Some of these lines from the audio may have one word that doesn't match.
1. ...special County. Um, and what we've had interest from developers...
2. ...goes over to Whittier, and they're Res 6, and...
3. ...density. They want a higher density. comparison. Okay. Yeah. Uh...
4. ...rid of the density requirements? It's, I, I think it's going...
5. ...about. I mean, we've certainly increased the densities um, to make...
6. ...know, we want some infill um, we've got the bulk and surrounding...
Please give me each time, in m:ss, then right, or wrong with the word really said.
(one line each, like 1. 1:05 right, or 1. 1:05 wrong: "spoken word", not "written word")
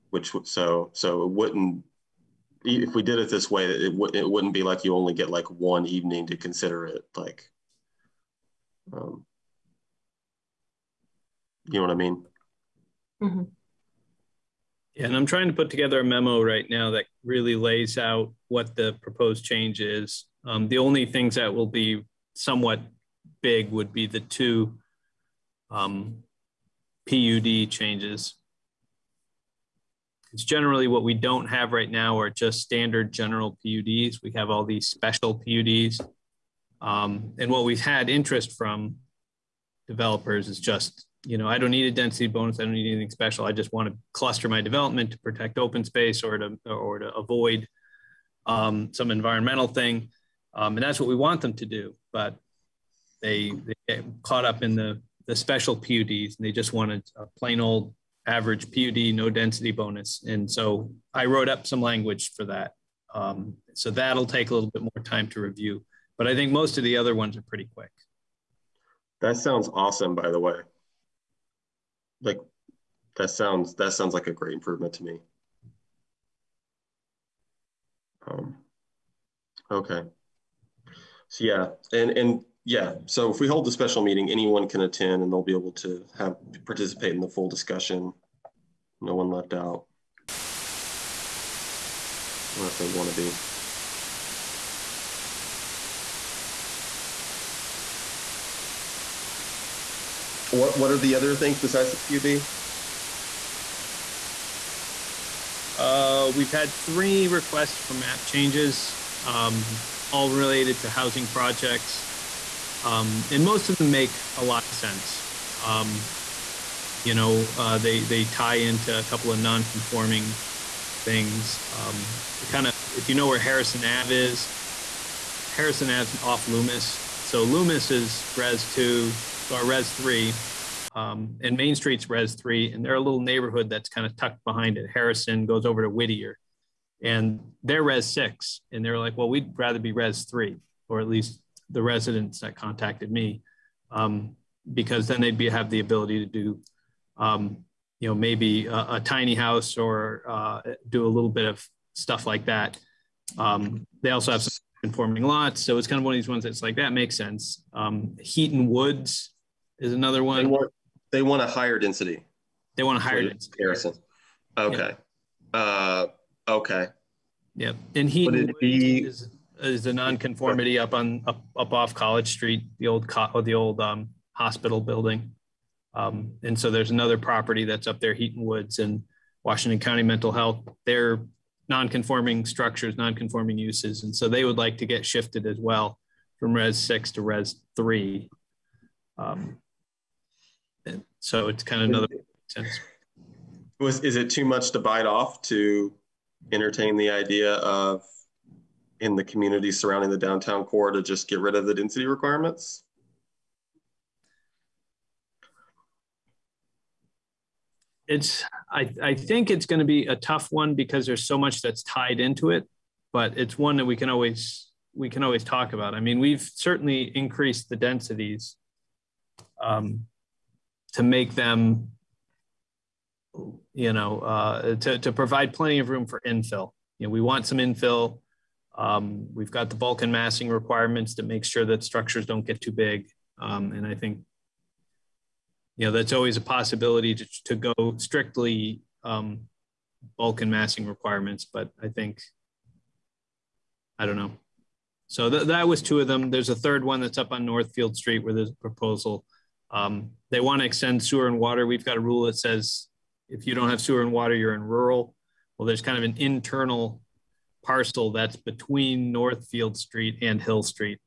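1. 0:34 wrong: "PUDs", not "County"
2. 2:15 right
3. 2:41 right
4. 3:21 right
5. 3:35 right
6. 3:47 wrong: "massing", not "surrounding".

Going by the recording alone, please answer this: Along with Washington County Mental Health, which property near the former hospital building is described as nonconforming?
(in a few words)
Heaton Woods.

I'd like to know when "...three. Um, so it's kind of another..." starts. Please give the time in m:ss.
3:07.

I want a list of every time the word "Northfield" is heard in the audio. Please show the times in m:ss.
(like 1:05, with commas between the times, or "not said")
4:07, 4:19.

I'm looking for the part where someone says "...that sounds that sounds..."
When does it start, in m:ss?
1:13.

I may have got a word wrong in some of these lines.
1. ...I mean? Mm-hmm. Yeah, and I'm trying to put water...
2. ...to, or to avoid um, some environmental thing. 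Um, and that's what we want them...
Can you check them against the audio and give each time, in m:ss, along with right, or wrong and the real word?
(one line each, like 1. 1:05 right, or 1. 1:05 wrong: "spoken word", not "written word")
1. 0:11 wrong: "together", not "water"
2. 0:46 right.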